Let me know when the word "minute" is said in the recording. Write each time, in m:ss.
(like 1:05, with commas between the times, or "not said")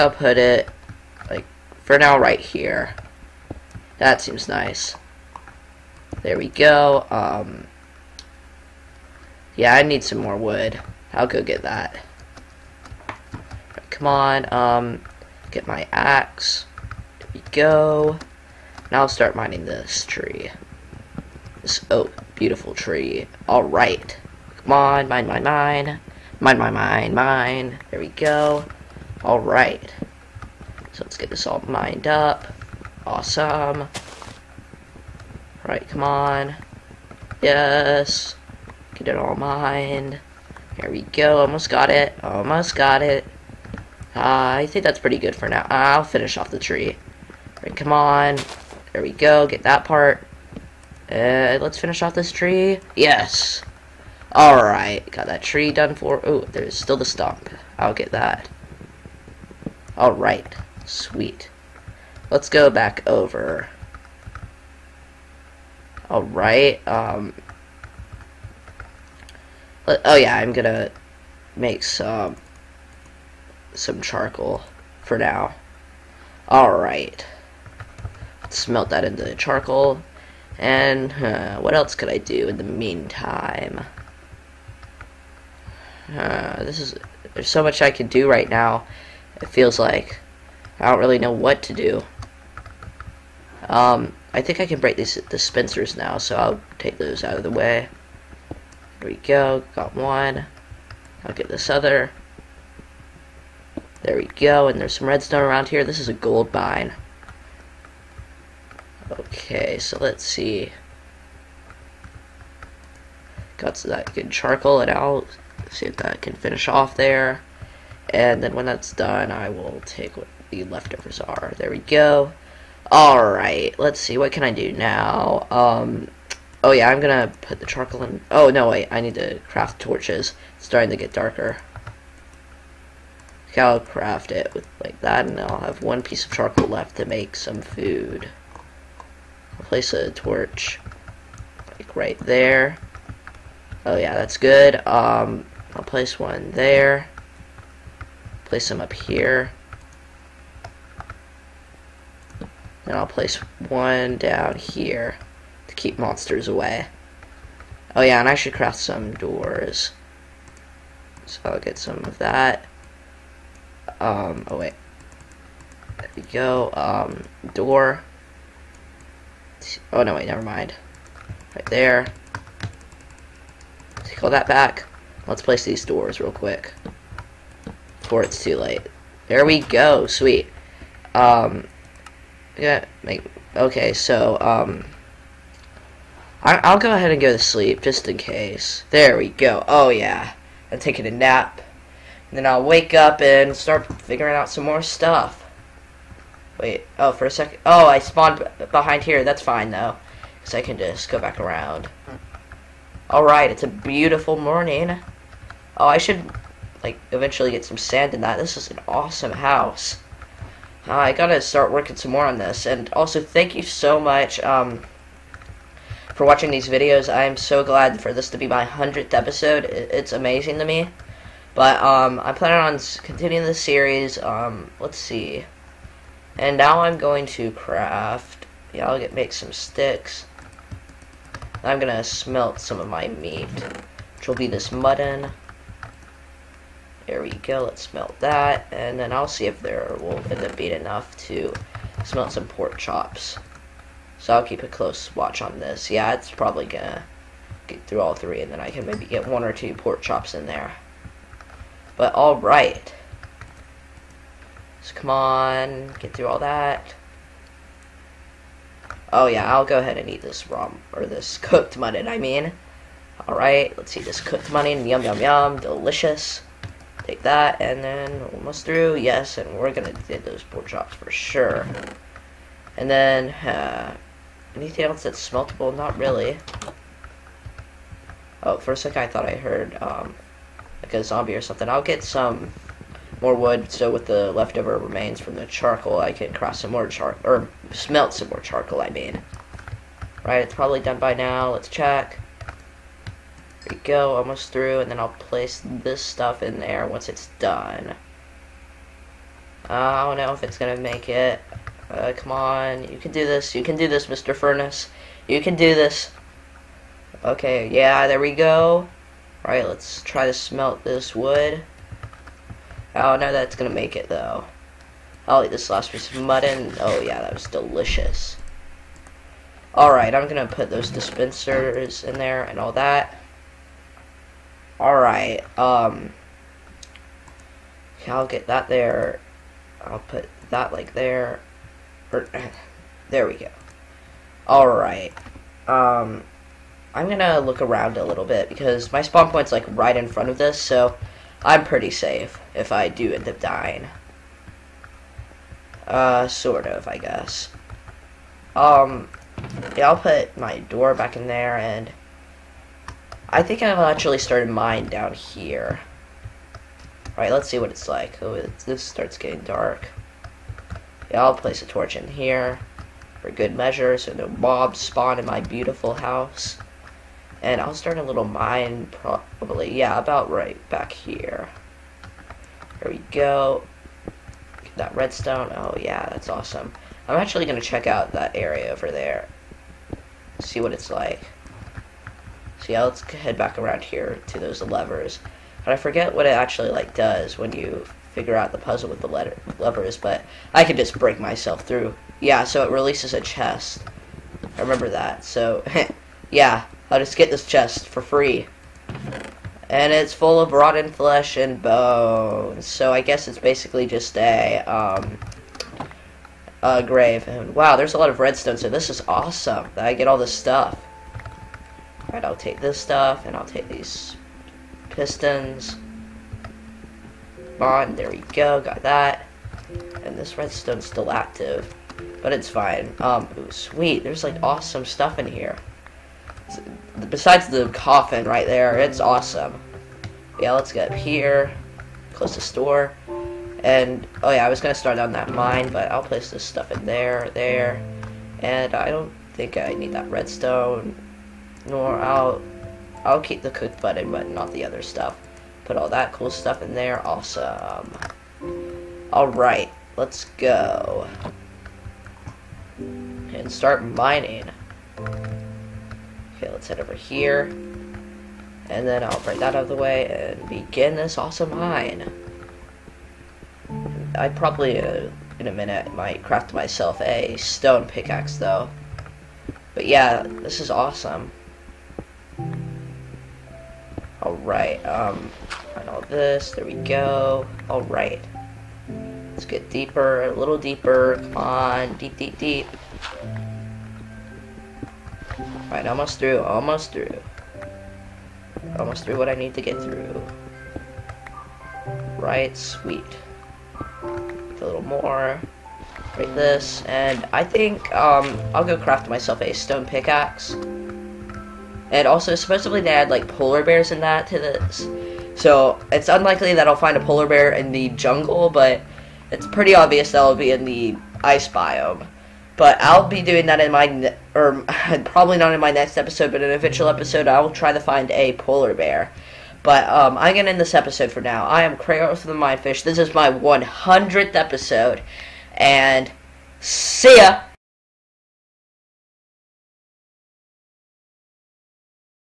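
7:45.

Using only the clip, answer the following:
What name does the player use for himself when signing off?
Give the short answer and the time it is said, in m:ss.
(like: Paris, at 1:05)
Kratos the MineFish, at 8:41.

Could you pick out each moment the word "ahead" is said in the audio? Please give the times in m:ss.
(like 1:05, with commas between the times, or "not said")
3:06, 4:19.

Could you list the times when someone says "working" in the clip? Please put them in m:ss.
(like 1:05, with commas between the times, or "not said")
3:31.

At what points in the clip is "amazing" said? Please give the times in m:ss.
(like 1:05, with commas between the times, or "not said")
3:40.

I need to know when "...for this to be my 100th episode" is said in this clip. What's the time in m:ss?
3:38.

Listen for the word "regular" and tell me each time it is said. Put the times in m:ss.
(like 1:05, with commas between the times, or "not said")
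not said.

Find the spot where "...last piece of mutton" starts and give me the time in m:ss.
5:15.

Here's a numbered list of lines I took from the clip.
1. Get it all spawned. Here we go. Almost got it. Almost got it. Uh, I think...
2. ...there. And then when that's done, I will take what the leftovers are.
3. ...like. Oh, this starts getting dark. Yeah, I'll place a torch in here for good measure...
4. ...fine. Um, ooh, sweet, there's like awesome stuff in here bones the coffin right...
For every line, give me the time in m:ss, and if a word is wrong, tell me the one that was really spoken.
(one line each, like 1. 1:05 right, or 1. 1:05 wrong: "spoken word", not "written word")
1. 0:38 wrong: "mined", not "spawned"
2. 1:56 right
3. 5:57 right
4. 7:02 wrong: "besides", not "bones".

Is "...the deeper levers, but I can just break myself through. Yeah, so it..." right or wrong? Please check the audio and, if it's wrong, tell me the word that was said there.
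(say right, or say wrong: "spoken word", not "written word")
wrong: "letter", not "deeper".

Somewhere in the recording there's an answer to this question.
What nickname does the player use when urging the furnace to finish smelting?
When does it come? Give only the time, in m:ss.
5:04.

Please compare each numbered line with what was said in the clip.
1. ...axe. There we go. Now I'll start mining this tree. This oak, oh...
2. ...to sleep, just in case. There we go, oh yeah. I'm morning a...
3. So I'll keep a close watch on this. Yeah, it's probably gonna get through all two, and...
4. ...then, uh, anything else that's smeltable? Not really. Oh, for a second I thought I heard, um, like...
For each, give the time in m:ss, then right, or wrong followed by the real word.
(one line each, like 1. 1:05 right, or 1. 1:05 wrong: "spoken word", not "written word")
1. 0:15 right
2. 3:07 wrong: "taking", not "morning"
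3. 4:04 wrong: "three", not "two"
4. 4:32 right.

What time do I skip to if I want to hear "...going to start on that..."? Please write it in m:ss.
7:14.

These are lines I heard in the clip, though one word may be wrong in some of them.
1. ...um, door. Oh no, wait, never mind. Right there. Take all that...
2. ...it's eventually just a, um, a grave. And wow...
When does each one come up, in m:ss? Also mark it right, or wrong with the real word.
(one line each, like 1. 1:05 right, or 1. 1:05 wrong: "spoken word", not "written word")
1. 2:46 right
2. 6:43 wrong: "basically", not "eventually".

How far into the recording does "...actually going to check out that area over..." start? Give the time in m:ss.
6:17.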